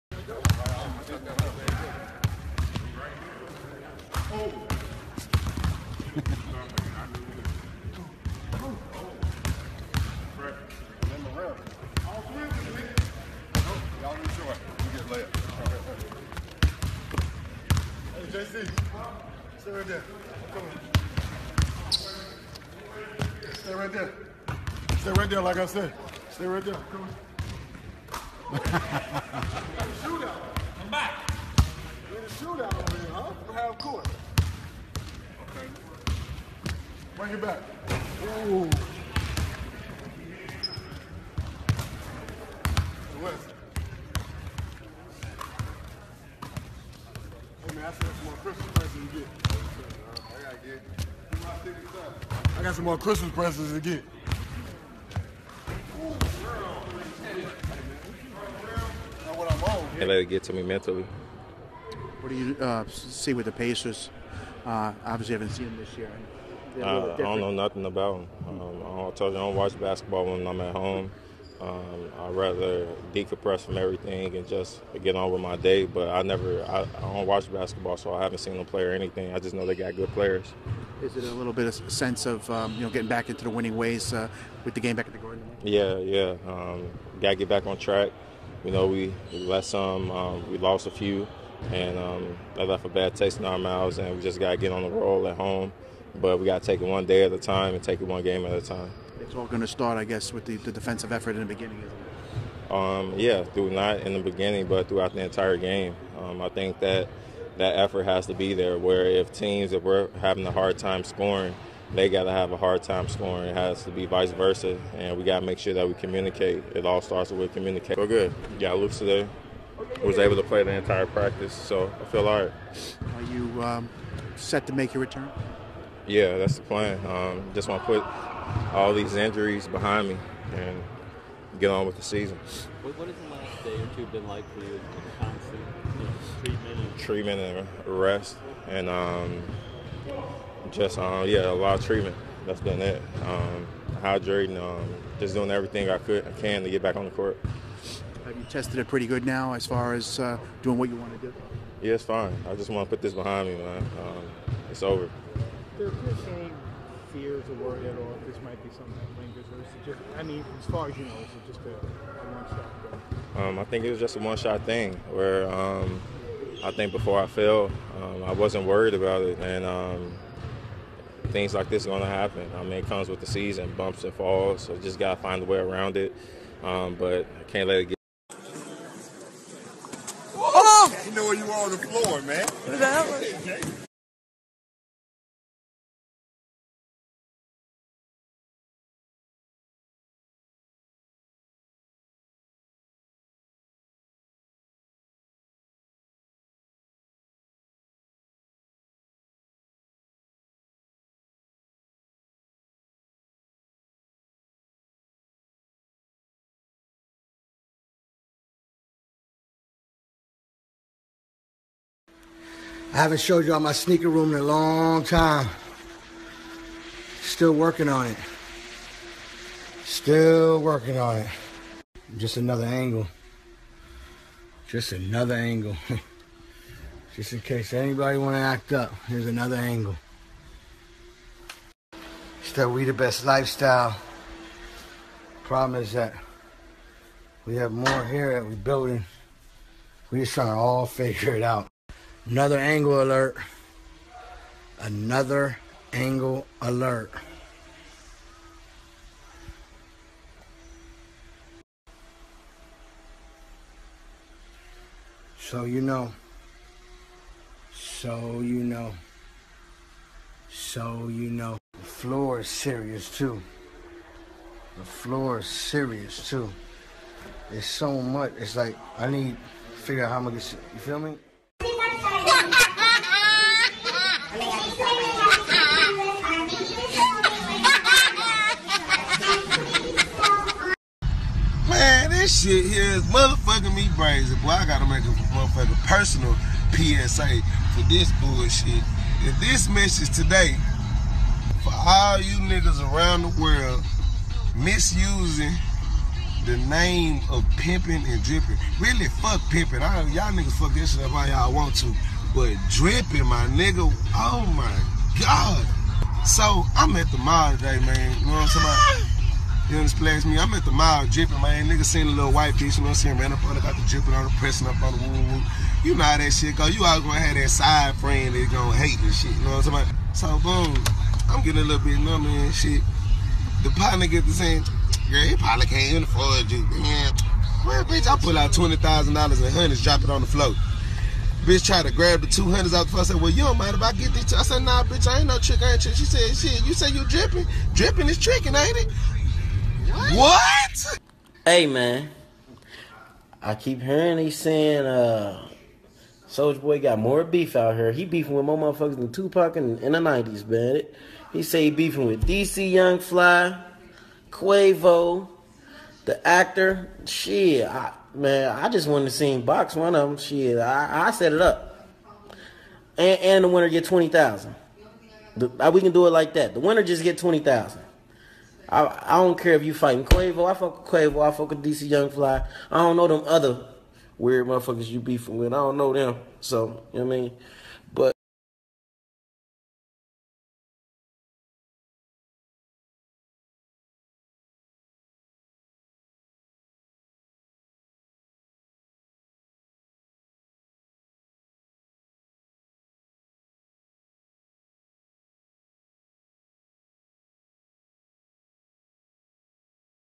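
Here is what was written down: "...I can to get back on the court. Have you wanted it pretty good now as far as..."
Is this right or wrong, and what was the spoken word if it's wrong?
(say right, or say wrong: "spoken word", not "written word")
wrong: "tested", not "wanted".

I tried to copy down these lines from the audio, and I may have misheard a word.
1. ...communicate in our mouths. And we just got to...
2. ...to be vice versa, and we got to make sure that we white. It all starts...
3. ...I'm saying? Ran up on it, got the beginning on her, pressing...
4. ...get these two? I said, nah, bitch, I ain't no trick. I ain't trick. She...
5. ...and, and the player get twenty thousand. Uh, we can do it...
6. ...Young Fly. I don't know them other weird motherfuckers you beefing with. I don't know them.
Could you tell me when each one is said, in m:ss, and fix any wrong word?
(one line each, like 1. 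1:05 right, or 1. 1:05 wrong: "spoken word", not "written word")
1. 1:33 wrong: "taste", not "communicate"
2. 1:53 wrong: "communicate", not "white"
3. 5:13 wrong: "dripping", not "beginning"
4. 5:33 right
5. 6:02 wrong: "winner", not "player"
6. 6:11 right.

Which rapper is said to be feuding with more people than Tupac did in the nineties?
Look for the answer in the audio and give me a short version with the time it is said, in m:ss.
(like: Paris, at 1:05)
Soulja Boy, at 5:46.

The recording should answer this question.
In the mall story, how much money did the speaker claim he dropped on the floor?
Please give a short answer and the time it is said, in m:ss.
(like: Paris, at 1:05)
$20,000, at 5:28.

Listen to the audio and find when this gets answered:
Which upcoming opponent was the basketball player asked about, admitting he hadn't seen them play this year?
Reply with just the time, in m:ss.
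1:03.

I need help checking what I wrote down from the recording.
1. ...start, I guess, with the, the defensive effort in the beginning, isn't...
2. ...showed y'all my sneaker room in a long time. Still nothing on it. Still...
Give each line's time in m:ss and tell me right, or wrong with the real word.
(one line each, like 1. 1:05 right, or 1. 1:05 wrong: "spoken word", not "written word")
1. 1:39 right
2. 3:33 wrong: "working", not "nothing".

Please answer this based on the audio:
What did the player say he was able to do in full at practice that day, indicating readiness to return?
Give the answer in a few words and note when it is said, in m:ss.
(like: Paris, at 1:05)
the entire practice, at 2:00.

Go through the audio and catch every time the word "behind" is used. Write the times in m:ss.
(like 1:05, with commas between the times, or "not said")
2:09, 2:33.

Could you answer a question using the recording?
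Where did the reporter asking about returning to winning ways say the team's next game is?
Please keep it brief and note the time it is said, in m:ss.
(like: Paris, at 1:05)
the Garden, at 1:25.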